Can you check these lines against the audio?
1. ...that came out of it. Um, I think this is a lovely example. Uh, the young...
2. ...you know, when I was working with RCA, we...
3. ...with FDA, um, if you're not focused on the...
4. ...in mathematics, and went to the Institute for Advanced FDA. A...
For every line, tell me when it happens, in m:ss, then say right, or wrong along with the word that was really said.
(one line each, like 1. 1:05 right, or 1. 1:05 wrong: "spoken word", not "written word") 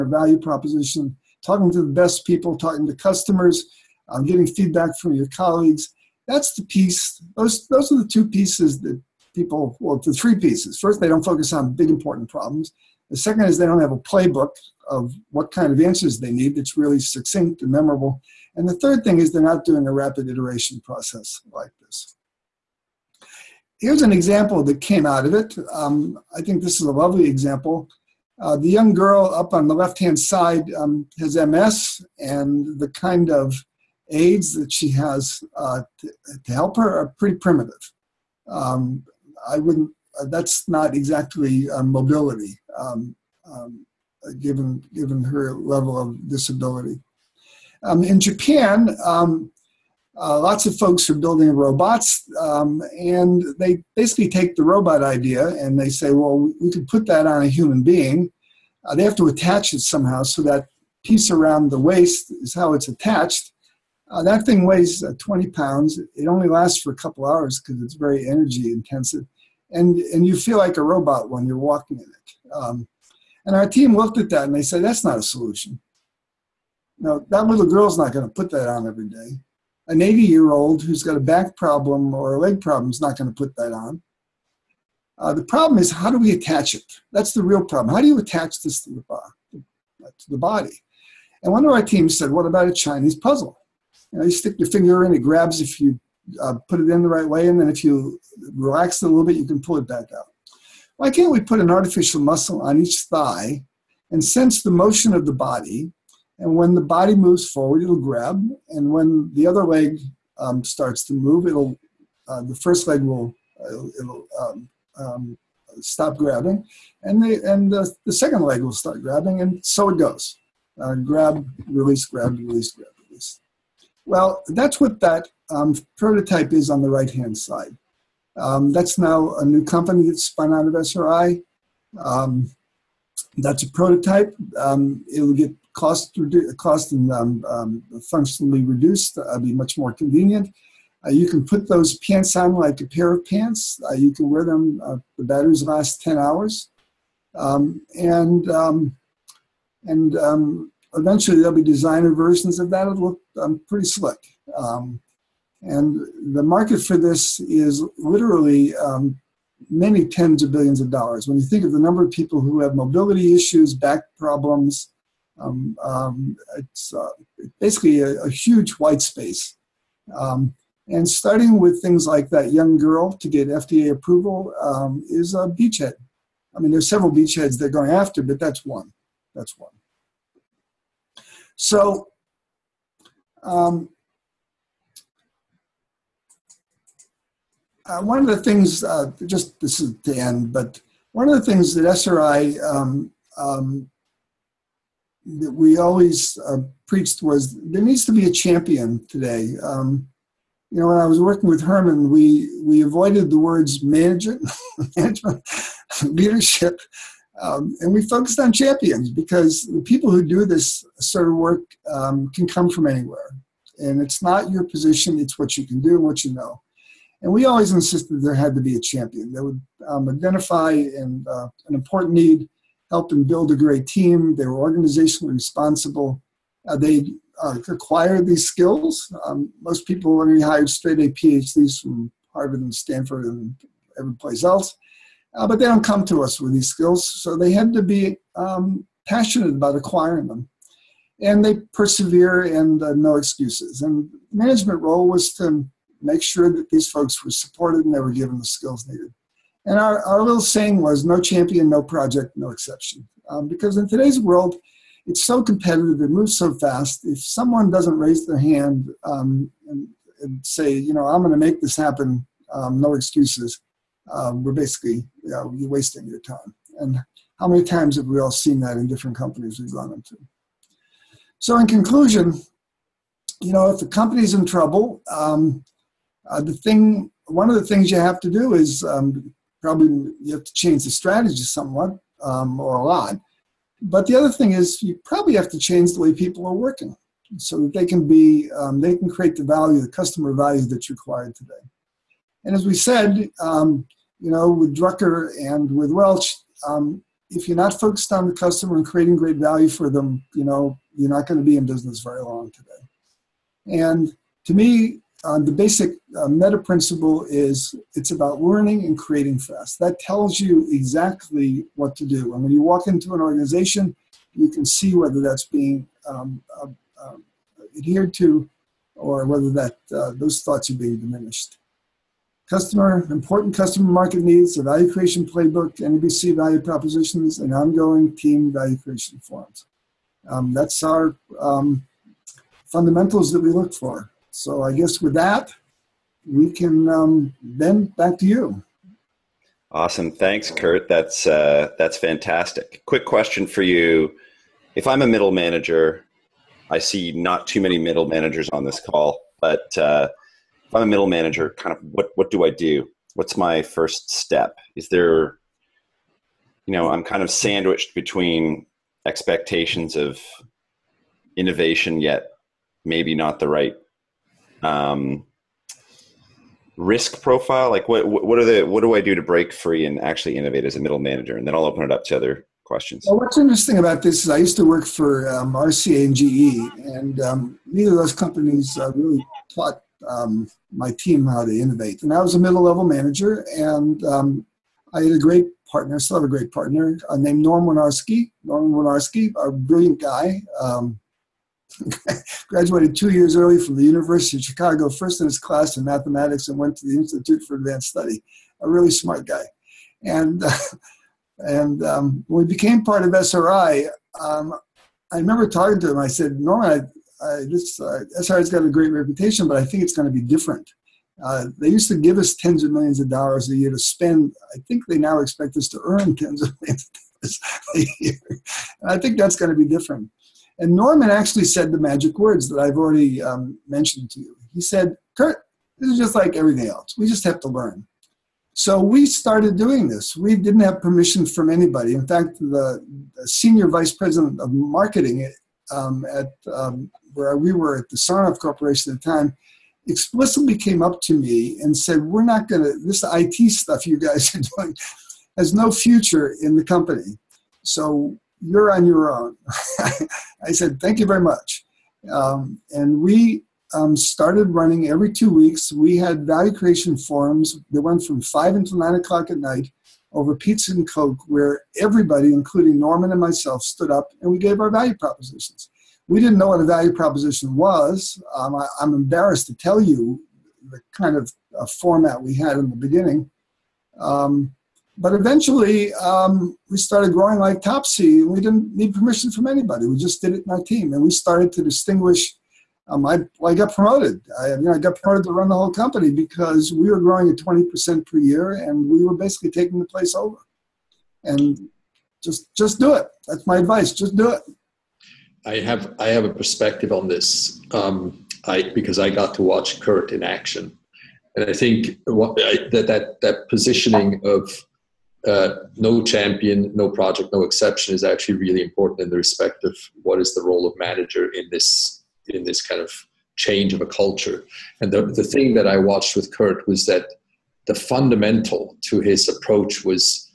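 1. 0:24 right
2. 3:20 wrong: "Herman", not "RCA"
3. 4:55 wrong: "Welch", not "FDA"
4. 6:35 wrong: "Study", not "FDA".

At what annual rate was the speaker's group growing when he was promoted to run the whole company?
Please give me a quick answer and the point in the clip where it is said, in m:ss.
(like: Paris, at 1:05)
20%, at 8:07.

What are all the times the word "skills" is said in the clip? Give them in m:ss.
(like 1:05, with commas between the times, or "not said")
3:48, 3:56, 4:08.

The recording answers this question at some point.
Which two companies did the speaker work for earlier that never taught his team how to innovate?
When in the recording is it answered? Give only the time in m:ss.
6:15.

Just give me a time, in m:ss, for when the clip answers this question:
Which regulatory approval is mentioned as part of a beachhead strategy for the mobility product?
2:53.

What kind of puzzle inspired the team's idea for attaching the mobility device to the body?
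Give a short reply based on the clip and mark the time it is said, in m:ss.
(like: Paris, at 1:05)
Chinese puzzle, at 1:32.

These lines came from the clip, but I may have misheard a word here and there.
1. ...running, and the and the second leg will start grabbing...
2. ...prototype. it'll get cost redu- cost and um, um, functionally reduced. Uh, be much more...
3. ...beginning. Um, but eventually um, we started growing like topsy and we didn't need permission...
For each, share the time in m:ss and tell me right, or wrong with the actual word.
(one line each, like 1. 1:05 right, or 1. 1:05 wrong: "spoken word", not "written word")
1. 1:56 wrong: "grabbing", not "running"
2. 2:13 right
3. 7:52 right.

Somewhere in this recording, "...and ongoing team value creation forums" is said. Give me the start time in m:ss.
5:27.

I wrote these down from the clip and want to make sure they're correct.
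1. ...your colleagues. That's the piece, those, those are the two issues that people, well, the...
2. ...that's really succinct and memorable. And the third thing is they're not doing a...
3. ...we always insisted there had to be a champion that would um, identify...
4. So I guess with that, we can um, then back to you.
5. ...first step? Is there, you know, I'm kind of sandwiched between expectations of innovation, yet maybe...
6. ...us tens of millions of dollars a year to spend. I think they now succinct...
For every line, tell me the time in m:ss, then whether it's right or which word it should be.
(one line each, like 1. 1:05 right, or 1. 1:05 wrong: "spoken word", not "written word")
1. 0:05 wrong: "pieces", not "issues"
2. 0:16 right
3. 3:37 right
4. 5:34 right
5. 5:53 right
6. 6:52 wrong: "expect", not "succinct".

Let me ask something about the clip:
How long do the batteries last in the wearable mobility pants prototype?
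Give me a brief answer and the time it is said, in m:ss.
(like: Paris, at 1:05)
10 hours, at 2:26.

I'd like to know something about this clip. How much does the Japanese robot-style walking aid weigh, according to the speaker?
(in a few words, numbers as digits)
20 pounds.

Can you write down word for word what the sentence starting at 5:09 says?
That tells you exactly what to do.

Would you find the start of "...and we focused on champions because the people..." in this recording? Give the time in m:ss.
3:27.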